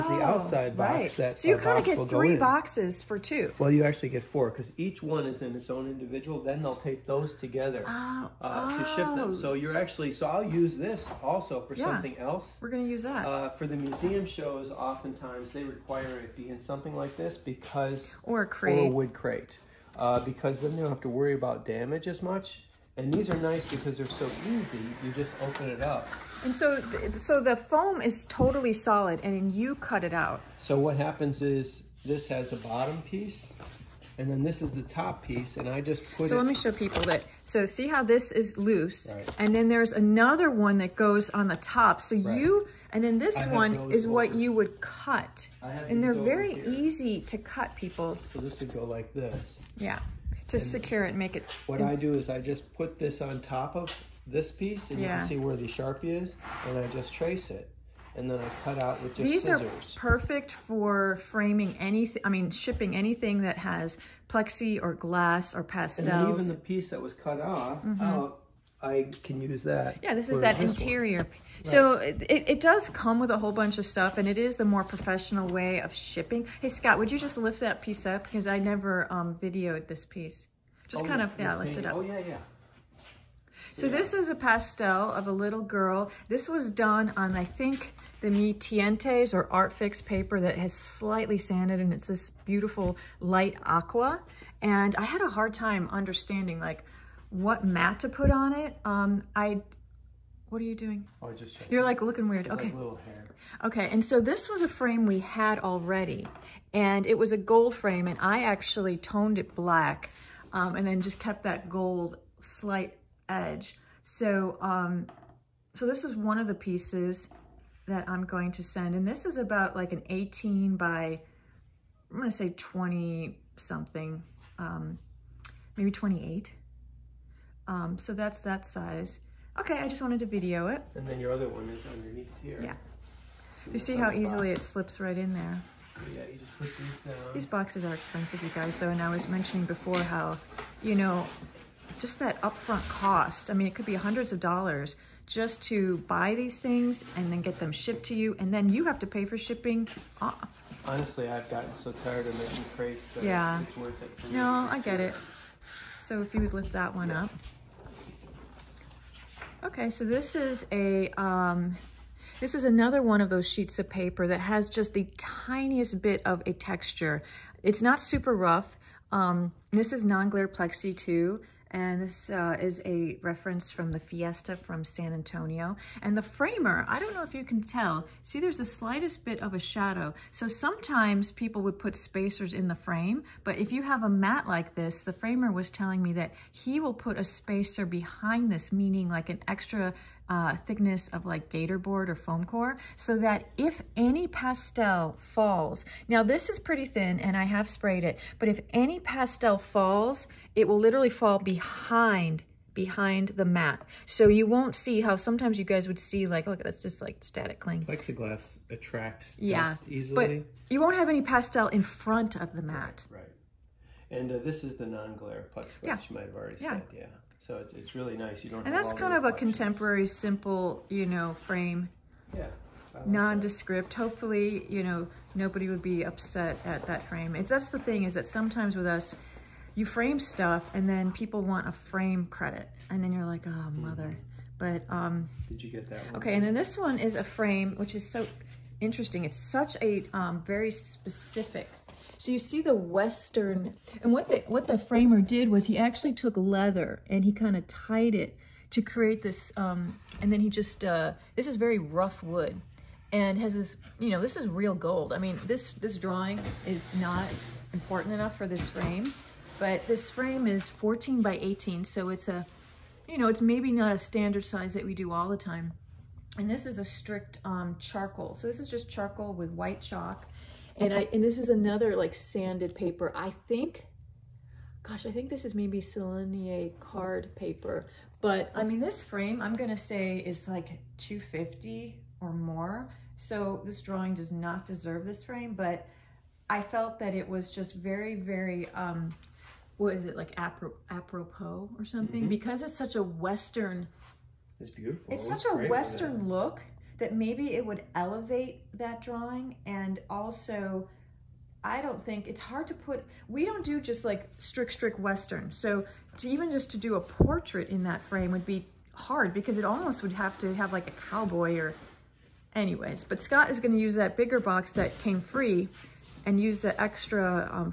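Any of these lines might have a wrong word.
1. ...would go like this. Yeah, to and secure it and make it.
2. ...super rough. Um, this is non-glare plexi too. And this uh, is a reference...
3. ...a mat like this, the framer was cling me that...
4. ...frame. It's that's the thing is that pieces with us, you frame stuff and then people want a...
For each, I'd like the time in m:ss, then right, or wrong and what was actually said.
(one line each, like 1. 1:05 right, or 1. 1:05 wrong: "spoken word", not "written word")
1. 0:48 right
2. 2:47 right
3. 3:04 wrong: "telling", not "cling"
4. 3:47 wrong: "sometimes", not "pieces".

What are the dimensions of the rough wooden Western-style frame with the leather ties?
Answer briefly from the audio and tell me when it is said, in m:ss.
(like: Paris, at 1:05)
14 by 18, at 4:20.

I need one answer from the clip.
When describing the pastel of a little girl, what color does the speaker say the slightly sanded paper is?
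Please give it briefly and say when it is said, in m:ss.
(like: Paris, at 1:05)
light aqua, at 1:33.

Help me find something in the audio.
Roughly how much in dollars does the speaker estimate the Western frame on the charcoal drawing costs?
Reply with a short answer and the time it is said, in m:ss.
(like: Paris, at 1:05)
250, at 4:40.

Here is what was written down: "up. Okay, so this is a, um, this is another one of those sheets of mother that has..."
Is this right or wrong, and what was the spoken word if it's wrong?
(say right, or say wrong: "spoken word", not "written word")
wrong: "paper", not "mother".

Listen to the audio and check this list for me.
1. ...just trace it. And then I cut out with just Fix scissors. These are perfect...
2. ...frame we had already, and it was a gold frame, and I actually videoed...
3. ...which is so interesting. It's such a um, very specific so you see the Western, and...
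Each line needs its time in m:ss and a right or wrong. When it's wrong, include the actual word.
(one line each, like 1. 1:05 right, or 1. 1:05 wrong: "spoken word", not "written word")
1. 0:56 wrong: "These", not "Fix"
2. 1:44 wrong: "toned", not "videoed"
3. 3:57 right.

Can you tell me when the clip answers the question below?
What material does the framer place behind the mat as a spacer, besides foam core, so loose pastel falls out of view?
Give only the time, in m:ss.
3:11.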